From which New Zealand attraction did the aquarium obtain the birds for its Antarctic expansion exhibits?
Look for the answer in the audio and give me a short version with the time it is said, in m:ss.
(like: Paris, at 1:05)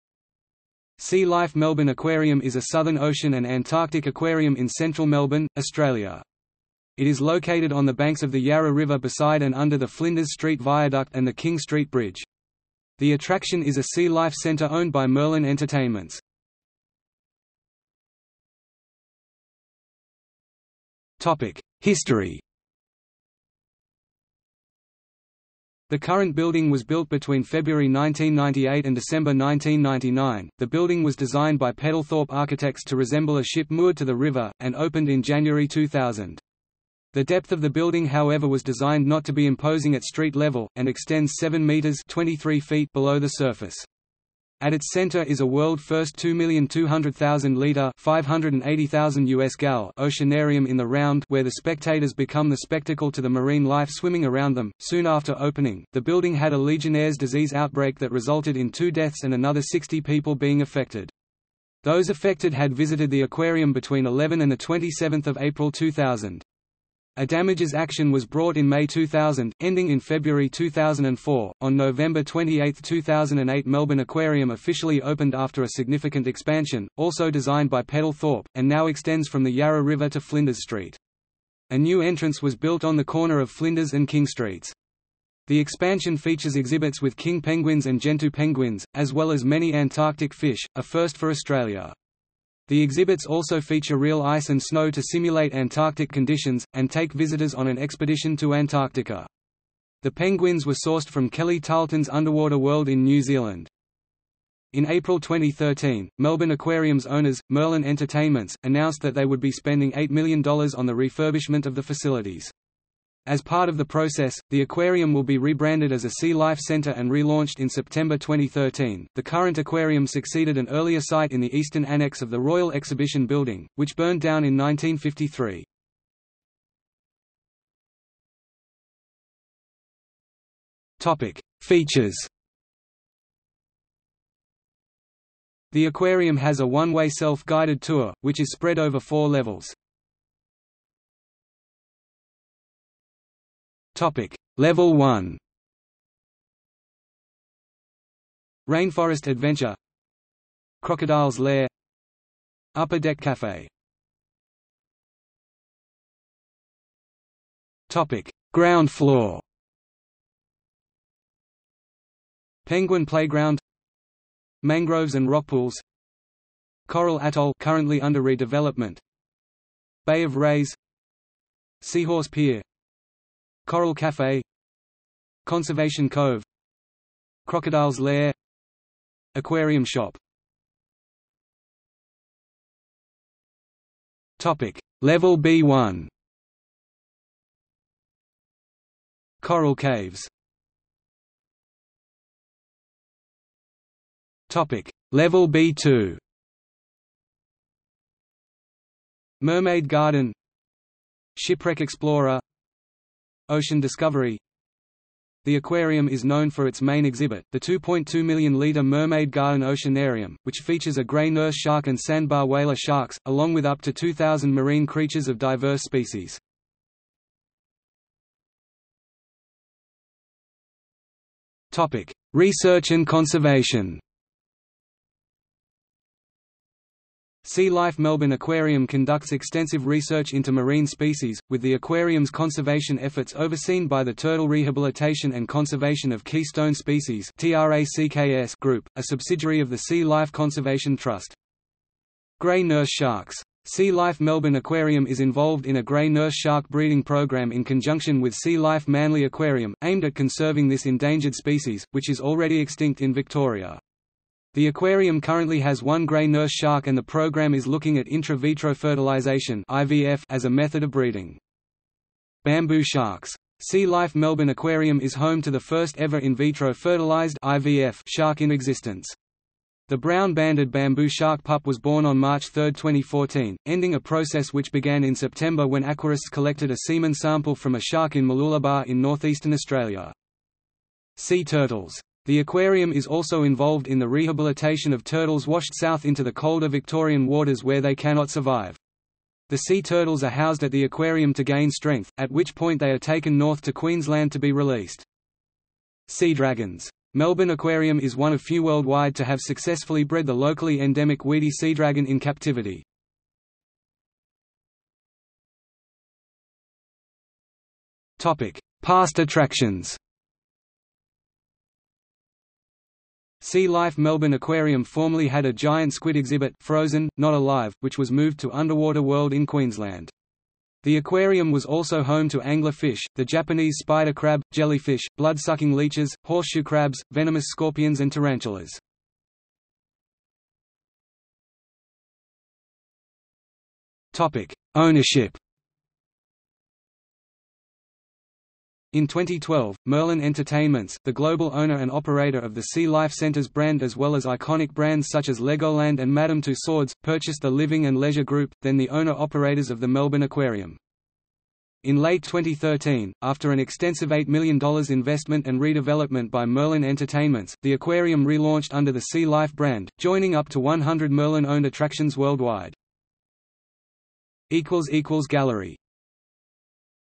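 Kelly Tarleton's Underwater World, at 1:41.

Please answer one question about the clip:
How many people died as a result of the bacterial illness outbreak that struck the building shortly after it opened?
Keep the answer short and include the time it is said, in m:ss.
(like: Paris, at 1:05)
2, at 0:58.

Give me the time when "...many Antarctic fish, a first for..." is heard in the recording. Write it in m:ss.
1:29.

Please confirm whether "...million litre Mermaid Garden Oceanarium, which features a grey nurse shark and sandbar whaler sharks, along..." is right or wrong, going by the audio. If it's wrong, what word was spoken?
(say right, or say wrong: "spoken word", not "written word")
right.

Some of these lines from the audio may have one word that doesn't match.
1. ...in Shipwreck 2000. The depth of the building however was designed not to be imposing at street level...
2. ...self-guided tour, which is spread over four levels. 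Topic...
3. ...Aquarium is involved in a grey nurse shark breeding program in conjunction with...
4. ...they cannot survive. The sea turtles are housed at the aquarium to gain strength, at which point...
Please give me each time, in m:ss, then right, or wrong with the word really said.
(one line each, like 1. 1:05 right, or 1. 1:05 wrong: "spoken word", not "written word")
1. 0:35 wrong: "January", not "Shipwreck"
2. 2:17 right
3. 4:04 right
4. 4:47 right.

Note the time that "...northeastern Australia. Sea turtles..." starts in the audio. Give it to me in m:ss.
4:39.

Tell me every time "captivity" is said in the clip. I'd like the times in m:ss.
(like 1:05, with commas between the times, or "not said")
5:02.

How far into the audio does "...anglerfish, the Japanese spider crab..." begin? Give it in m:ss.
5:22.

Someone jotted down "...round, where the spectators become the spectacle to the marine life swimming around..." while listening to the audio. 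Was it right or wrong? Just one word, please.
right.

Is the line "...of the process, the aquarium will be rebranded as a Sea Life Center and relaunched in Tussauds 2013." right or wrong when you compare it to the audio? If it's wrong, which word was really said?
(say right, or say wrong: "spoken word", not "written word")
wrong: "September", not "Tussauds".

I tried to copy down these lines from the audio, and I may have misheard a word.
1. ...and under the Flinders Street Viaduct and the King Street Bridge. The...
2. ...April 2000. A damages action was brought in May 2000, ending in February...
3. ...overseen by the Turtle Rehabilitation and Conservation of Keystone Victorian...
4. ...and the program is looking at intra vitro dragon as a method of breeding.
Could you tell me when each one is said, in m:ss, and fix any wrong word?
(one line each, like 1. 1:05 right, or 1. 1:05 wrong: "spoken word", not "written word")
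1. 0:09 right
2. 1:05 right
3. 3:53 wrong: "Species", not "Victorian"
4. 4:16 wrong: "fertilization", not "dragon".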